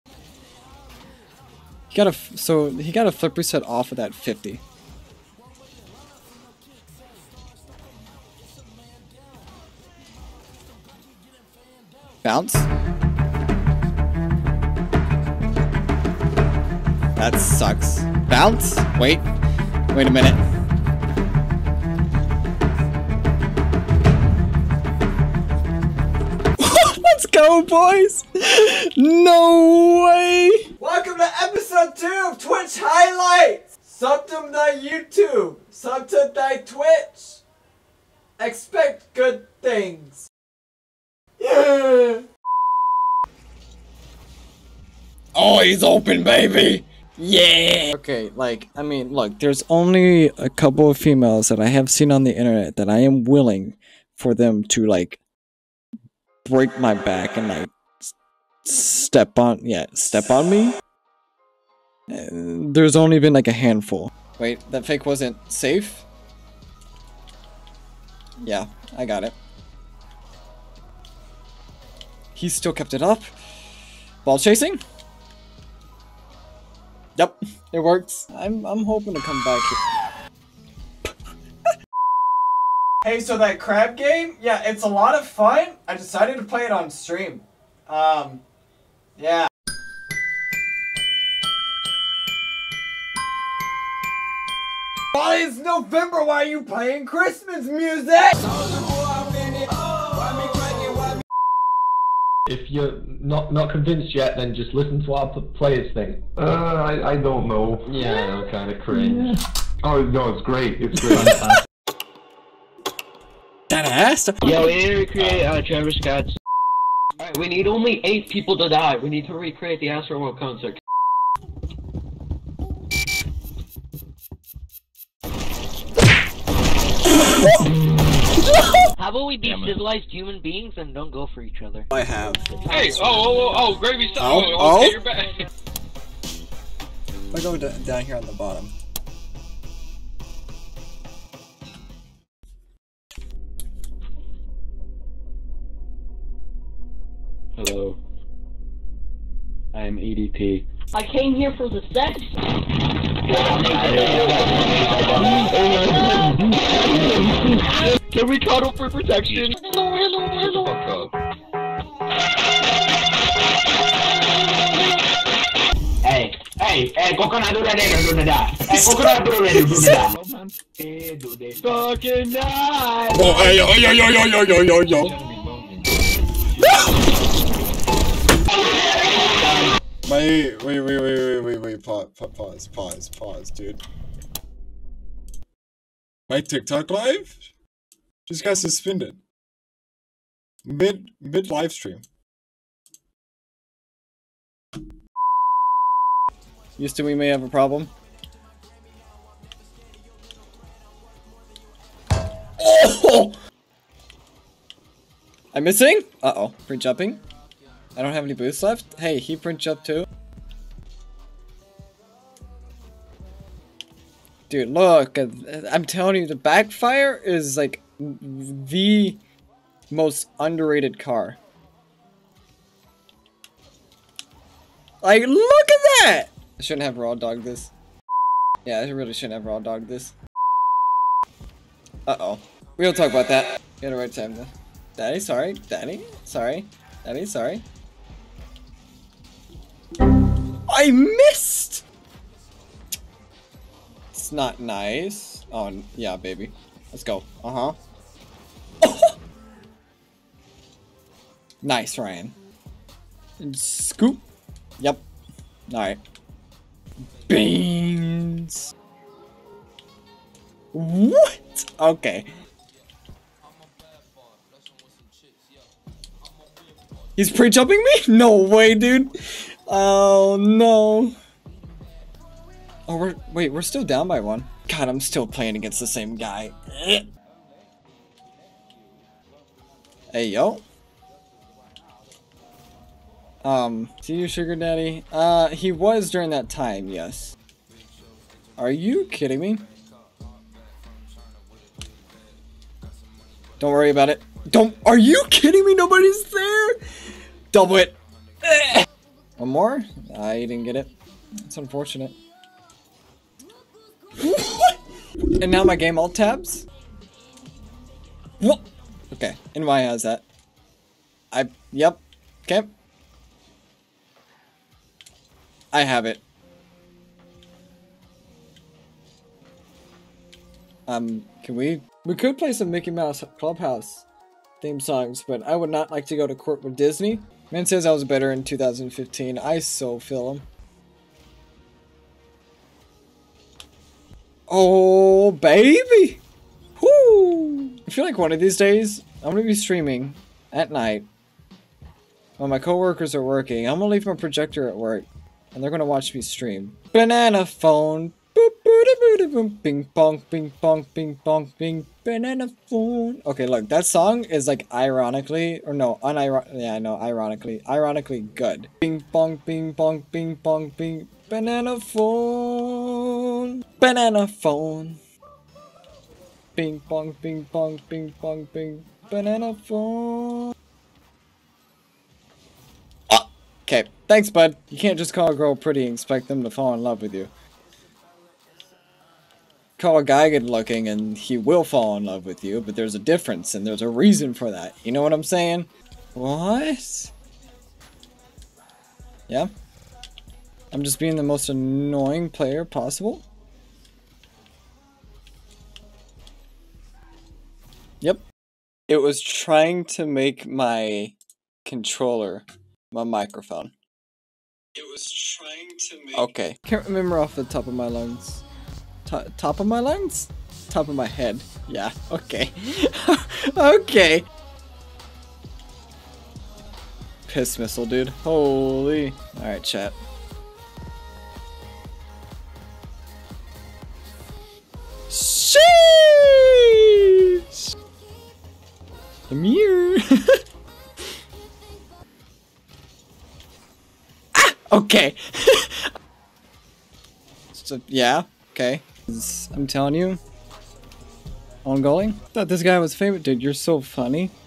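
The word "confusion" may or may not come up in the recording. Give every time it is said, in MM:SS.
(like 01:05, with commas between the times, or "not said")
not said.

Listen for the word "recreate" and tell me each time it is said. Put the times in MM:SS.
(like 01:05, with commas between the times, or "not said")
01:54, 01:59.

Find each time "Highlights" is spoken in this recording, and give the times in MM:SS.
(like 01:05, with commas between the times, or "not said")
00:32.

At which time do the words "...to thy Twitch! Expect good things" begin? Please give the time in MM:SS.
00:36.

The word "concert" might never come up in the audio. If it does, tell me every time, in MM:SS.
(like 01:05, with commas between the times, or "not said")
02:00.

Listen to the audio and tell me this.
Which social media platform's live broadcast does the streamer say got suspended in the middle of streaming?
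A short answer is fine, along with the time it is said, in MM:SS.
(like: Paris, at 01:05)
TikTok, at 03:06.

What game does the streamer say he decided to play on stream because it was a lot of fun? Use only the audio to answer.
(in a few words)
Crab Game.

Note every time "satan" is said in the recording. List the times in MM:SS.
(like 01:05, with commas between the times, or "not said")
not said.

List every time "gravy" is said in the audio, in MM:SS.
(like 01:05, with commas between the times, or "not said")
02:13.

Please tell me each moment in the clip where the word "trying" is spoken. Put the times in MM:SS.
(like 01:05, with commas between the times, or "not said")
06:39, 06:45.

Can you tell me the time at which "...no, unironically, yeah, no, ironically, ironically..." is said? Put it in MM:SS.
05:55.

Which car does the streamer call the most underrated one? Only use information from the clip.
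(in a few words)
Backfire.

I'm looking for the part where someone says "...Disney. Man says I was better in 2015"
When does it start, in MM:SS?
05:26.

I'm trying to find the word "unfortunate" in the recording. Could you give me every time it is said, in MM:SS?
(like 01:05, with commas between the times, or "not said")
05:01.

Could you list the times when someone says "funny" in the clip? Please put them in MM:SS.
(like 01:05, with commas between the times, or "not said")
07:23.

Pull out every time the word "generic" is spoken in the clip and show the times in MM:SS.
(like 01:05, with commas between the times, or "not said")
not said.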